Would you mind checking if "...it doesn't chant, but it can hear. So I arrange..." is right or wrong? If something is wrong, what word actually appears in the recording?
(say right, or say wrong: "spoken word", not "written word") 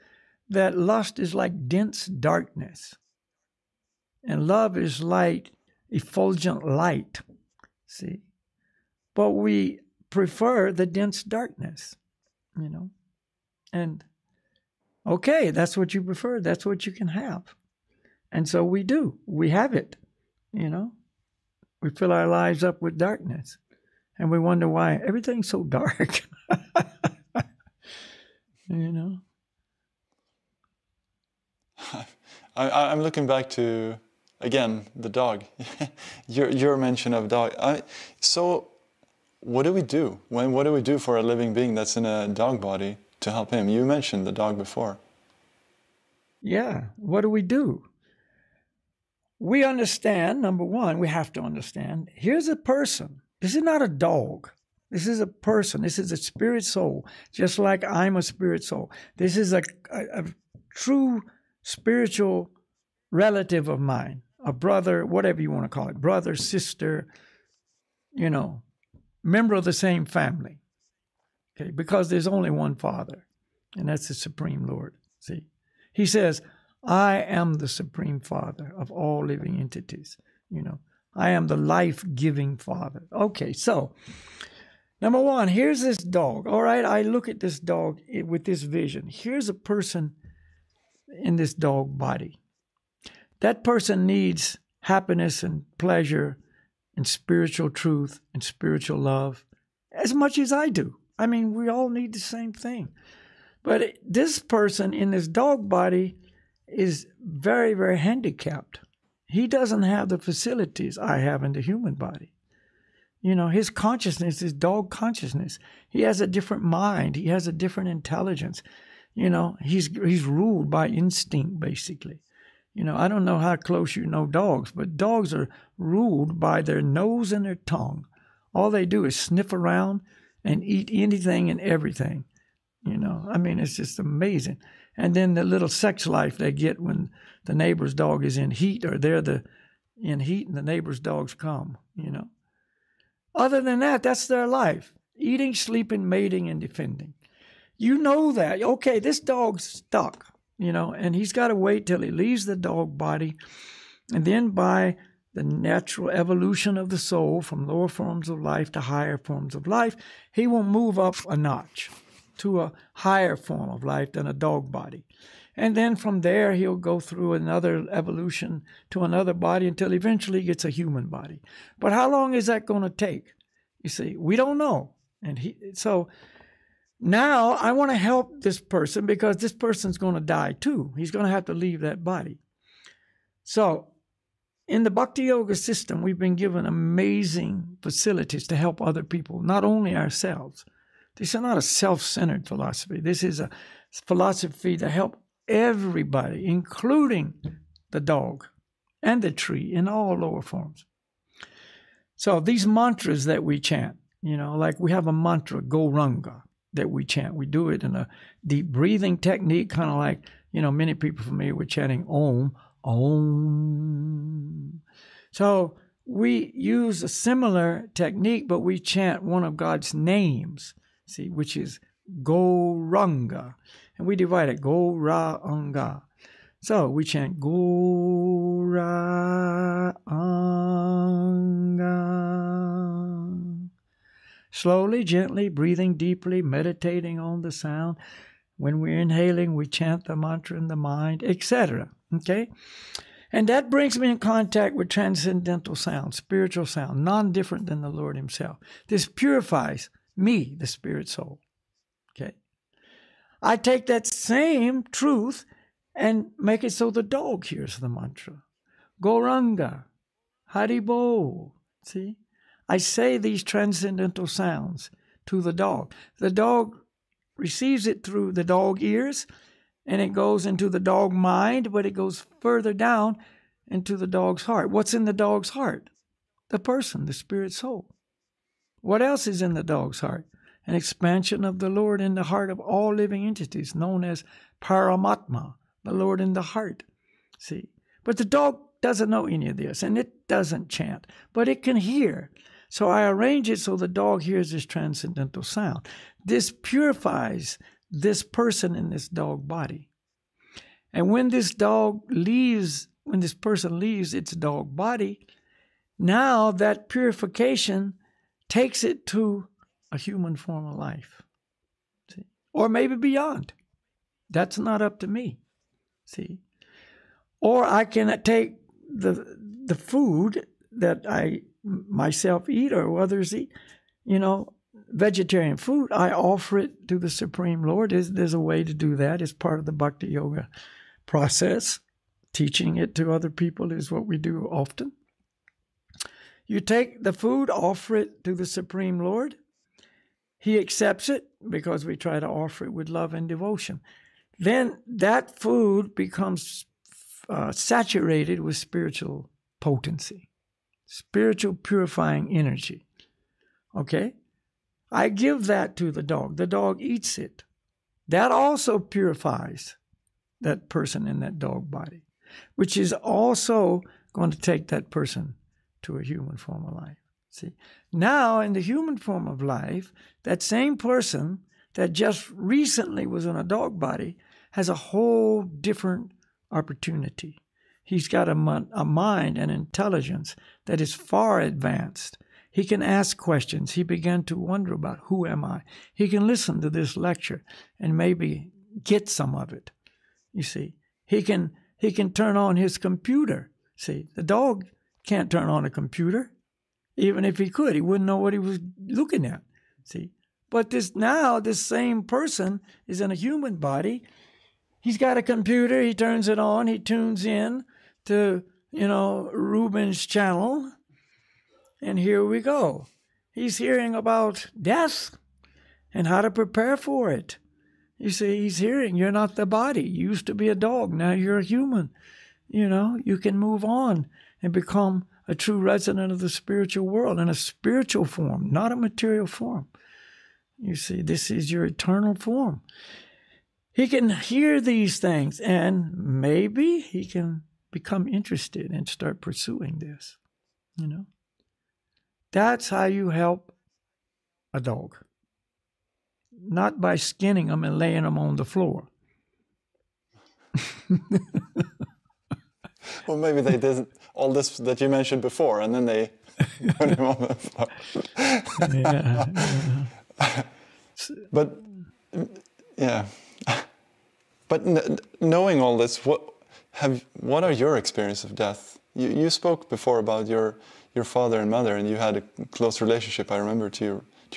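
right.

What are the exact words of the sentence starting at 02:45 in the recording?
And then from there, he'll go through another evolution to another body until eventually he gets a human body.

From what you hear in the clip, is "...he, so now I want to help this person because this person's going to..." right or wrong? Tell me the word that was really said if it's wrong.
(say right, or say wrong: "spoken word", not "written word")
right.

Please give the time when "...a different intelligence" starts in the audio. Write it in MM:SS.
01:57.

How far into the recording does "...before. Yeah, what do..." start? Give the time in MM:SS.
00:44.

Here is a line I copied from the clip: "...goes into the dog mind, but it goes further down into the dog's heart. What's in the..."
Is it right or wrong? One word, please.
right.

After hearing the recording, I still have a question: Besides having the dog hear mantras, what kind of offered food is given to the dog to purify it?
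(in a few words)
Vegetarian food.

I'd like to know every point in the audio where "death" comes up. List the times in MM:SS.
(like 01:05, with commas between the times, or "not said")
06:54, 07:48.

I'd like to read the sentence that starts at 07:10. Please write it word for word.
You see, this is your eternal form.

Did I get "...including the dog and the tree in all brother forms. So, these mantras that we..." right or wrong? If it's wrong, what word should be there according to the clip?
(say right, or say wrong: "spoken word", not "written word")
wrong: "lower", not "brother".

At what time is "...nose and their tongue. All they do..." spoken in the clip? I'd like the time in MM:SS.
02:06.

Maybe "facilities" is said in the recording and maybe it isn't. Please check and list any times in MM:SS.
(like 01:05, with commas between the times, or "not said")
01:50, 03:07.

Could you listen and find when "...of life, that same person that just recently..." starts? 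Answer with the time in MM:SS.
06:09.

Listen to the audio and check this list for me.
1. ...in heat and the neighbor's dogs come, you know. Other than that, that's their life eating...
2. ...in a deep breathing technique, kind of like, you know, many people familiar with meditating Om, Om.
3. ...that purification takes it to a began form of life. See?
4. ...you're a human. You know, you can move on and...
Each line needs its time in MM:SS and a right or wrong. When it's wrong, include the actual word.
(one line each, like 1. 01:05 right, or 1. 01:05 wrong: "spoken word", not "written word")
1. 02:19 right
2. 03:27 wrong: "chanting", not "meditating"
3. 05:06 wrong: "human", not "began"
4. 07:01 right.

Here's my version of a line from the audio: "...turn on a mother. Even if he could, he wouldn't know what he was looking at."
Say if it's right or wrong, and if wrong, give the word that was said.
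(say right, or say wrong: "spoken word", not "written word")
wrong: "computer", not "mother".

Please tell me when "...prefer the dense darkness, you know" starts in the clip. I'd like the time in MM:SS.
00:10.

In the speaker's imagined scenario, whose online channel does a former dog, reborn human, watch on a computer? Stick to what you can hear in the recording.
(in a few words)
Ruben's.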